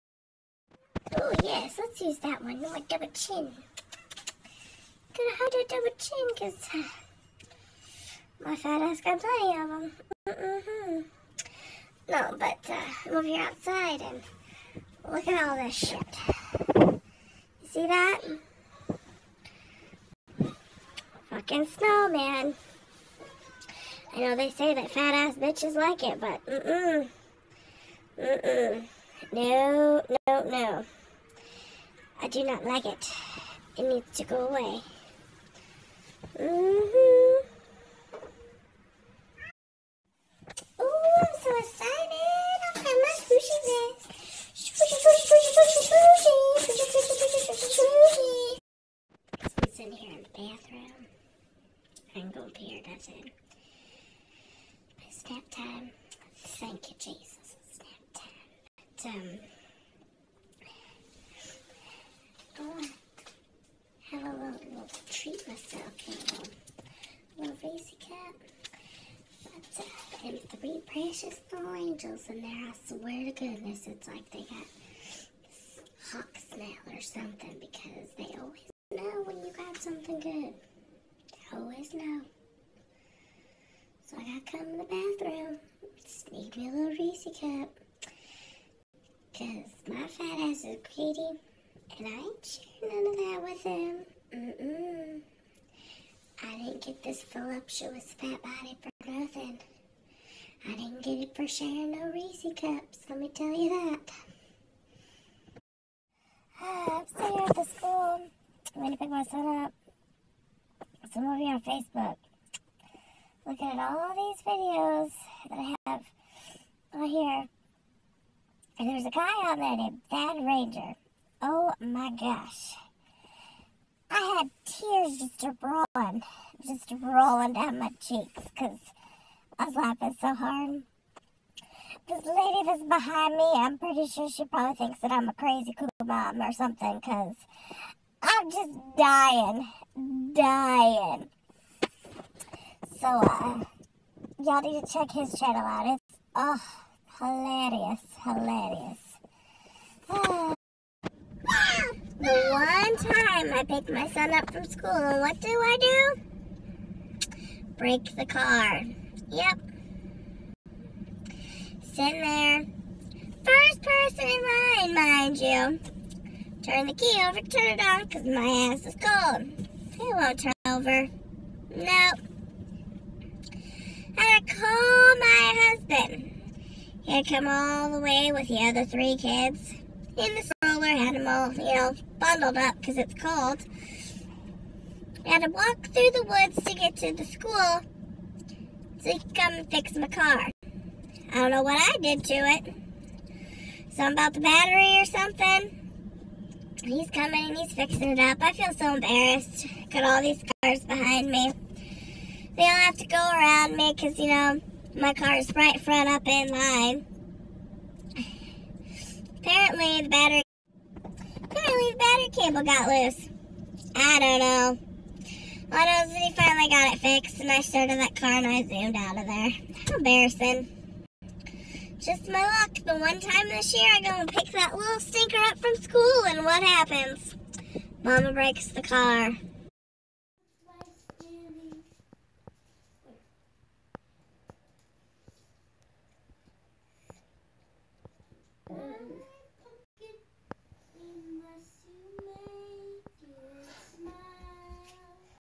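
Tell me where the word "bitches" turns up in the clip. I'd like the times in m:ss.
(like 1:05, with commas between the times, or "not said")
0:25.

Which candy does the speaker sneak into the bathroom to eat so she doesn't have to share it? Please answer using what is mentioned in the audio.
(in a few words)
Reese cup.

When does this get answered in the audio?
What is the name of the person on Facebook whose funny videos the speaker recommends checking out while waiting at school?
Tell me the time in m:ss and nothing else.
2:00.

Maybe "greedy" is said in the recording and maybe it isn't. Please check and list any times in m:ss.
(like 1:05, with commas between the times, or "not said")
1:30.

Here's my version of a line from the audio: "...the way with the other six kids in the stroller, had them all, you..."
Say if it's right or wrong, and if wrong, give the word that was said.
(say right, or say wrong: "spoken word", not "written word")
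wrong: "three", not "six".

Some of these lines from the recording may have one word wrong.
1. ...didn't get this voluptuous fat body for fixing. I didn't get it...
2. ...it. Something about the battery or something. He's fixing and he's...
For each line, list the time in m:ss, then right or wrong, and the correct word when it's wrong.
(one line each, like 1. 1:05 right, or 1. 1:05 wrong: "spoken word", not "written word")
1. 1:36 wrong: "nothing", not "fixing"
2. 3:12 wrong: "coming", not "fixing".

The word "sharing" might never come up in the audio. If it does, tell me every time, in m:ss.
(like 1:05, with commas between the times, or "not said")
1:32, 1:41.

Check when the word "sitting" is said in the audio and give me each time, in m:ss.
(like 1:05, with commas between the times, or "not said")
1:47, 2:41.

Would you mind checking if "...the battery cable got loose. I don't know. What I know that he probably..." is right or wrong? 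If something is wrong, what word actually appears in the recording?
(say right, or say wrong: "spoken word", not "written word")
wrong: "finally", not "probably".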